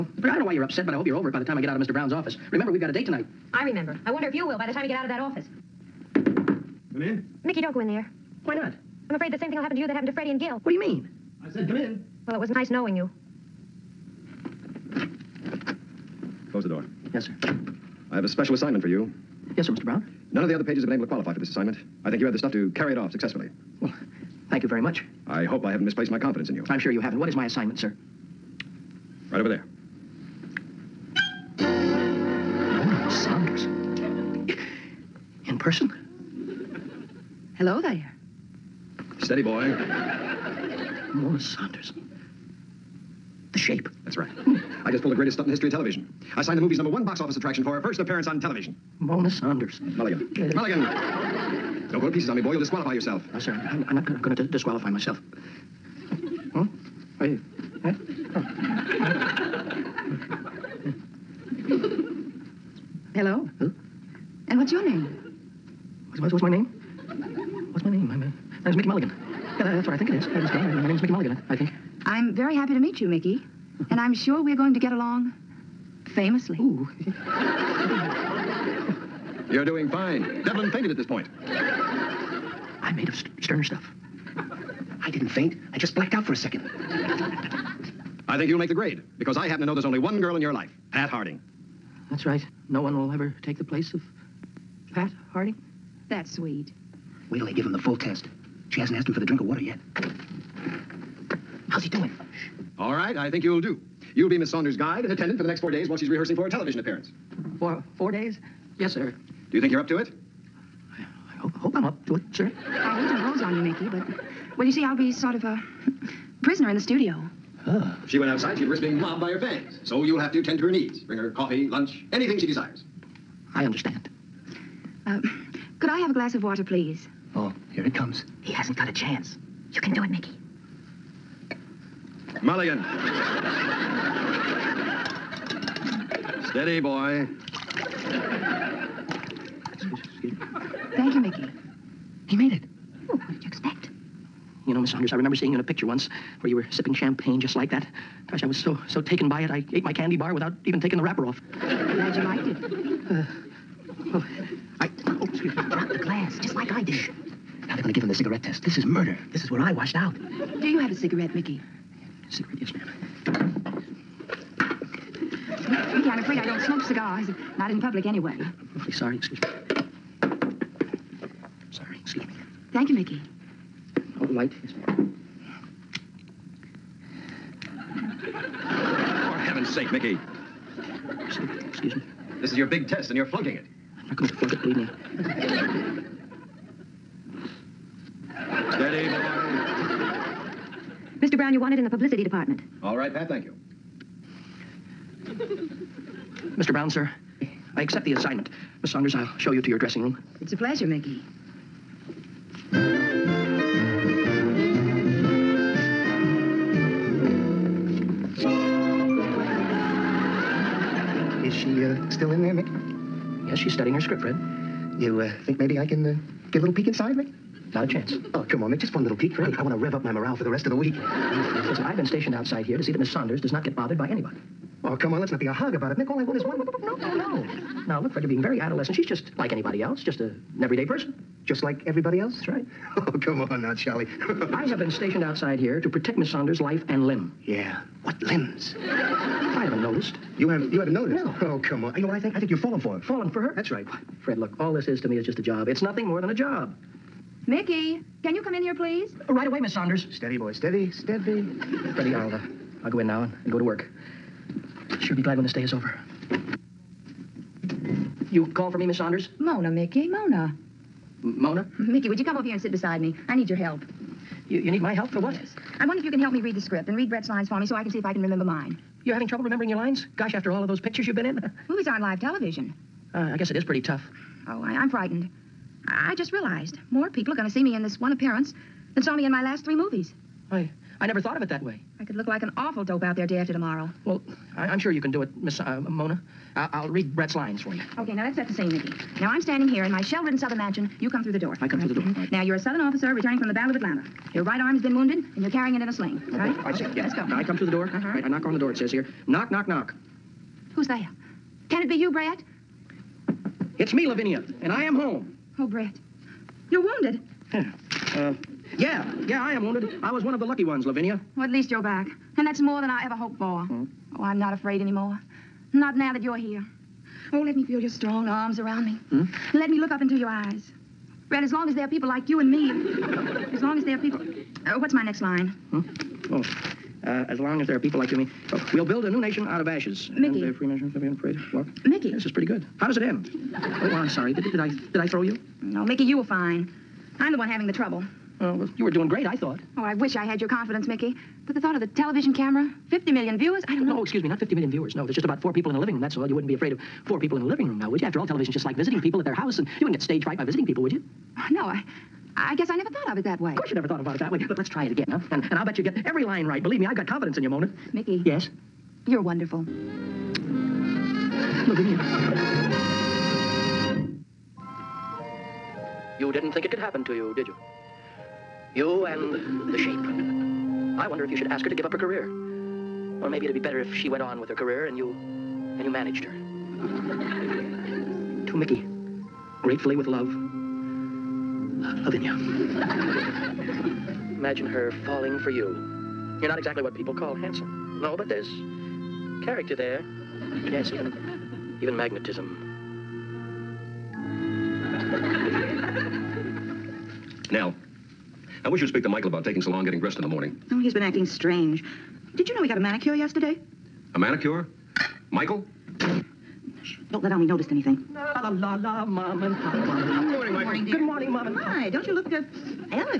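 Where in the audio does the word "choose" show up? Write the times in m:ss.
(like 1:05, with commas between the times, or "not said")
not said.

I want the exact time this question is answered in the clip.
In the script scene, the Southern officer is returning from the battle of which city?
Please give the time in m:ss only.
4:53.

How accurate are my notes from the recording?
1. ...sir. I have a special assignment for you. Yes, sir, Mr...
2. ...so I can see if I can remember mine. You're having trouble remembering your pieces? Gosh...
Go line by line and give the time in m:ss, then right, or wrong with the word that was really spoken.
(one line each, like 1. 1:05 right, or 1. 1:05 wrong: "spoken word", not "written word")
1. 0:17 right
2. 4:27 wrong: "lines", not "pieces".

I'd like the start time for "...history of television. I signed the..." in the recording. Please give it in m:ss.
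0:45.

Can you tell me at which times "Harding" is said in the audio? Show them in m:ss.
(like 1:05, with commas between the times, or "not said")
1:31, 1:35.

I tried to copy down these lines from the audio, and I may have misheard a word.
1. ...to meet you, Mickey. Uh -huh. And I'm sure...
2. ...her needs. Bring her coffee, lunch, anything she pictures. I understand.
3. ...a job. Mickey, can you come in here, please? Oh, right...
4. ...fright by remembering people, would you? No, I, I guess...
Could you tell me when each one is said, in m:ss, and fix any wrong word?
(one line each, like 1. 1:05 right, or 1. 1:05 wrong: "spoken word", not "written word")
1. 1:12 right
2. 2:00 wrong: "desires", not "pictures"
3. 4:06 right
4. 5:50 wrong: "visiting", not "remembering".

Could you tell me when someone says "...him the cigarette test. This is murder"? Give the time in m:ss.
2:38.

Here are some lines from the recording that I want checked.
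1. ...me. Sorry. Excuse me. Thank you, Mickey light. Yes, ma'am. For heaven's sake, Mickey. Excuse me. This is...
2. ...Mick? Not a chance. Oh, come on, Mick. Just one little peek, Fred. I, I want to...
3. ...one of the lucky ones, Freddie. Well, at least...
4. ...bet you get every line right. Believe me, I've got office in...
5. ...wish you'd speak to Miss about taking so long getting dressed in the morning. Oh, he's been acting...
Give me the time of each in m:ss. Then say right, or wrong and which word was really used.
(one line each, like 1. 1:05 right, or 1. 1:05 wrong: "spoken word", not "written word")
1. 2:49 right
2. 3:37 right
3. 5:10 wrong: "Lavinia", not "Freddie"
4. 5:55 wrong: "confidence", not "office"
5. 6:38 wrong: "Michael", not "Miss".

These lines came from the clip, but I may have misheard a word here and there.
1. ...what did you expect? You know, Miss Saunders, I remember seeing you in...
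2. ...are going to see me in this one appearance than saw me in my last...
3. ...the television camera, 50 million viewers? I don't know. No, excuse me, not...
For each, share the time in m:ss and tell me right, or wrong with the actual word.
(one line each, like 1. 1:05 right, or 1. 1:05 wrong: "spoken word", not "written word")
1. 2:23 right
2. 4:37 right
3. 5:41 right.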